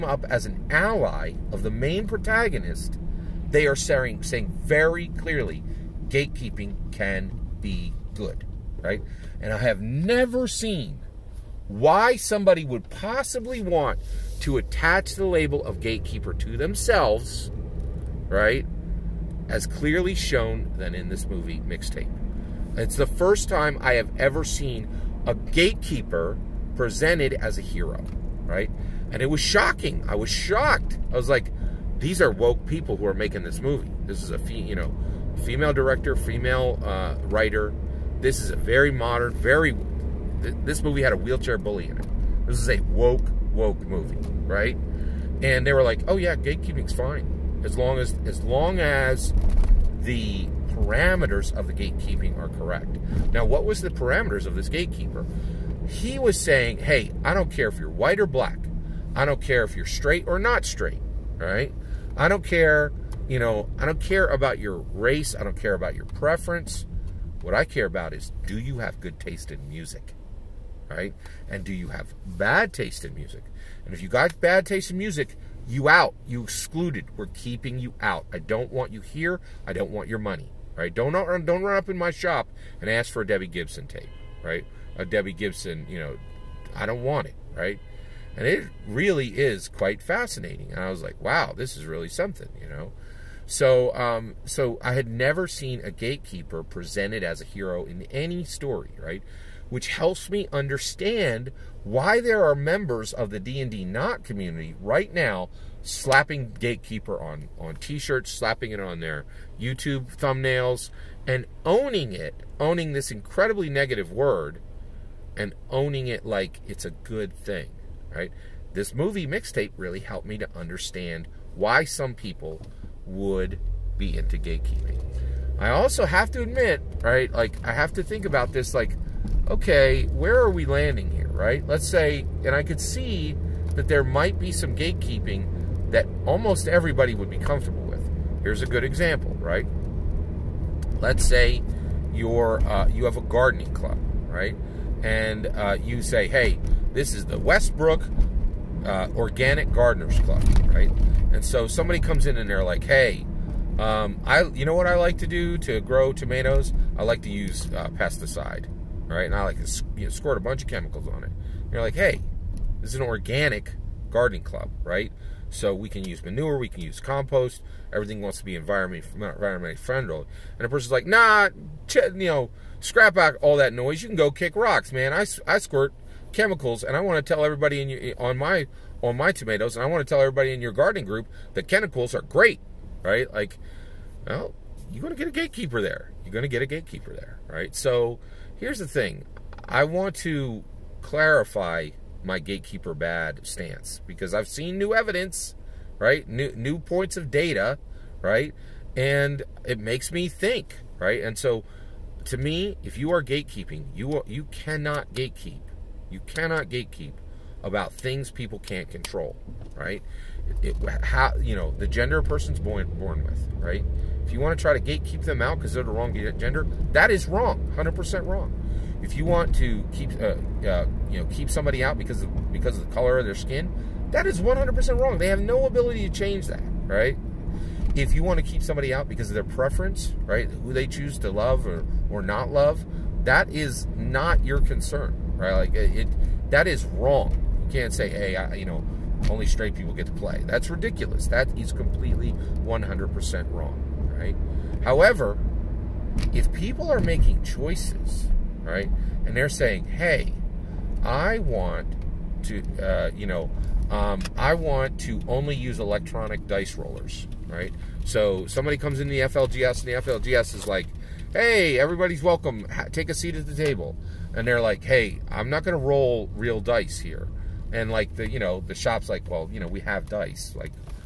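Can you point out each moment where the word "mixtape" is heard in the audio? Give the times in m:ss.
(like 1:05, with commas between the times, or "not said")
0:21, 1:59.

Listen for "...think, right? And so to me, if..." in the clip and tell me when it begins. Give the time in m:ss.
3:20.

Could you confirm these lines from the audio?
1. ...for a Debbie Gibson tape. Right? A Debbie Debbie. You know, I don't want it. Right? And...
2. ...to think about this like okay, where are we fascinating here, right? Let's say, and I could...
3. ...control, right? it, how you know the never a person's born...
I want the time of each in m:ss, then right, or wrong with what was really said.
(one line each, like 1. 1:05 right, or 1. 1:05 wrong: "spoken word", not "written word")
1. 1:23 wrong: "Gibson", not "Debbie"
2. 2:07 wrong: "landing", not "fascinating"
3. 3:28 wrong: "gender", not "never".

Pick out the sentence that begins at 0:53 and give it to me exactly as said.
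Now, what was the parameters of this gatekeeper?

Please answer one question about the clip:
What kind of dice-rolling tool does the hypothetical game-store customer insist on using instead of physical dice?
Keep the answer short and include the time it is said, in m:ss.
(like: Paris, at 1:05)
electronic dice rollers, at 4:15.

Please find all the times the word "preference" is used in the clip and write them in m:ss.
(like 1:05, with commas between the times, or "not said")
1:06, 3:49.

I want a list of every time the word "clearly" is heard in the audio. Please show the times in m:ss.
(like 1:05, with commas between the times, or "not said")
0:05, 0:19.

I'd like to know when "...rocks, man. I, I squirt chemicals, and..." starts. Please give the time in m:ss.
2:54.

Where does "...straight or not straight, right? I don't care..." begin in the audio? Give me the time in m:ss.
0:59.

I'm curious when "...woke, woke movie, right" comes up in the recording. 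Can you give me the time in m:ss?
0:42.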